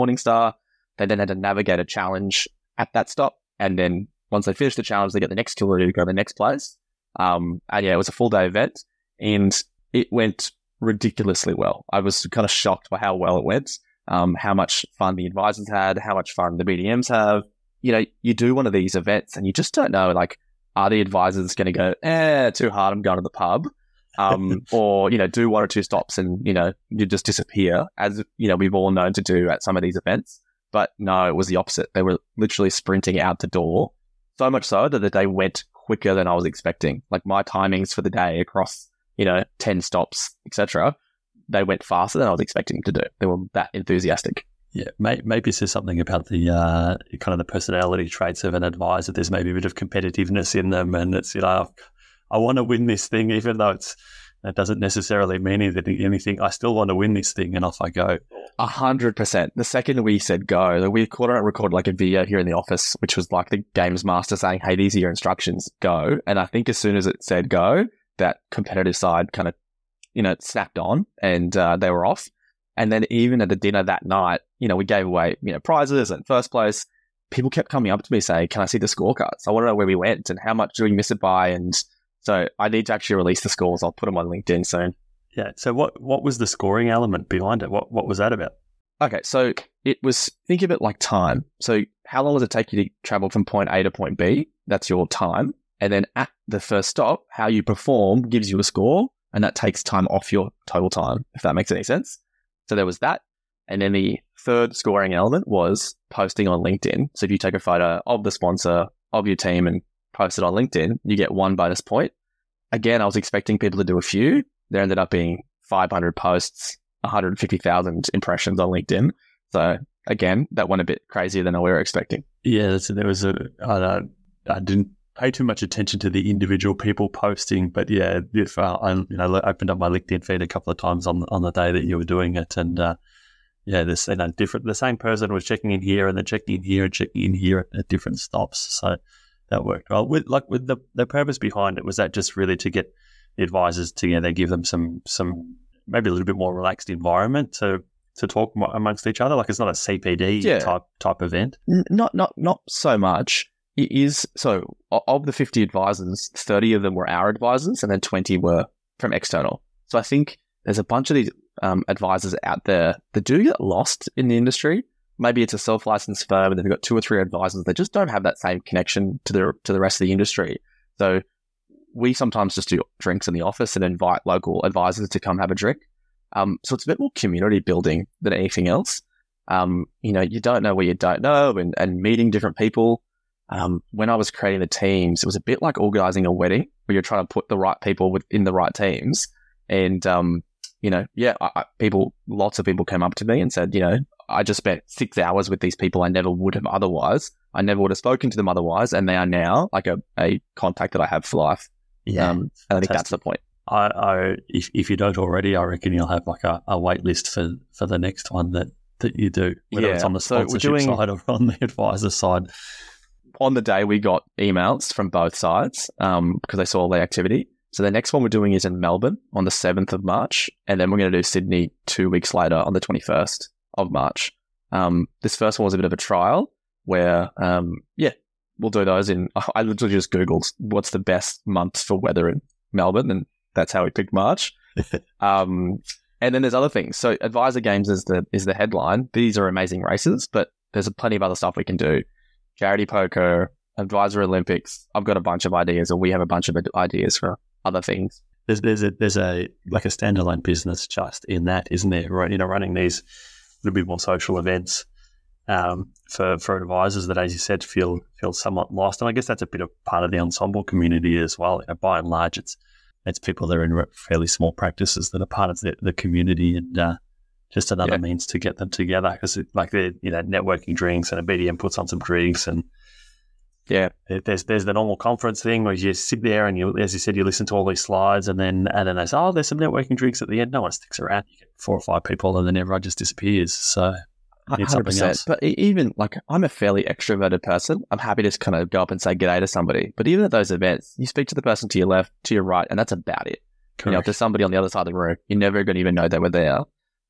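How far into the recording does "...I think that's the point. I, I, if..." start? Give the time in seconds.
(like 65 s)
202 s.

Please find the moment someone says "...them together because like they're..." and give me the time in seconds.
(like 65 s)
268 s.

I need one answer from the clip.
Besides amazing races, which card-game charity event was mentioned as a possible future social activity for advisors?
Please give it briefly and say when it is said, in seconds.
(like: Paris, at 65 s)
Charity poker, at 242 s.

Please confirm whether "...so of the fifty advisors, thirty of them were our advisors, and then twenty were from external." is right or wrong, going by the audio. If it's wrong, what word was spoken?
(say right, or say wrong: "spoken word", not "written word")
right.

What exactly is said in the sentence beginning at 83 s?
I'll put them on LinkedIn soon.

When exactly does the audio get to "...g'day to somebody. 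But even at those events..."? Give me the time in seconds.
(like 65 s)
289 s.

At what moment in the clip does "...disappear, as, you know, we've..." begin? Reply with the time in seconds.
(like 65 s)
27 s.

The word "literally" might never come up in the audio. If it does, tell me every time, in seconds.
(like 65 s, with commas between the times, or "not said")
32 s, 229 s.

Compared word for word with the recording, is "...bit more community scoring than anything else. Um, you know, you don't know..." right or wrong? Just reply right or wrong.
wrong.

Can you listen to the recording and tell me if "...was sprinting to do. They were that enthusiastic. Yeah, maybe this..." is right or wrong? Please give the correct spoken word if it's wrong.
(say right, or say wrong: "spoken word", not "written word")
wrong: "expecting", not "sprinting".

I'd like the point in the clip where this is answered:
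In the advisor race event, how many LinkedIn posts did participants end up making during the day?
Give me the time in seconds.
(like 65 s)
115 s.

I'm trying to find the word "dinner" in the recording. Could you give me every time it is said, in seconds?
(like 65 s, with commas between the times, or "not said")
73 s.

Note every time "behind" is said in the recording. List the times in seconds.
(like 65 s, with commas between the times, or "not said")
87 s, 141 s.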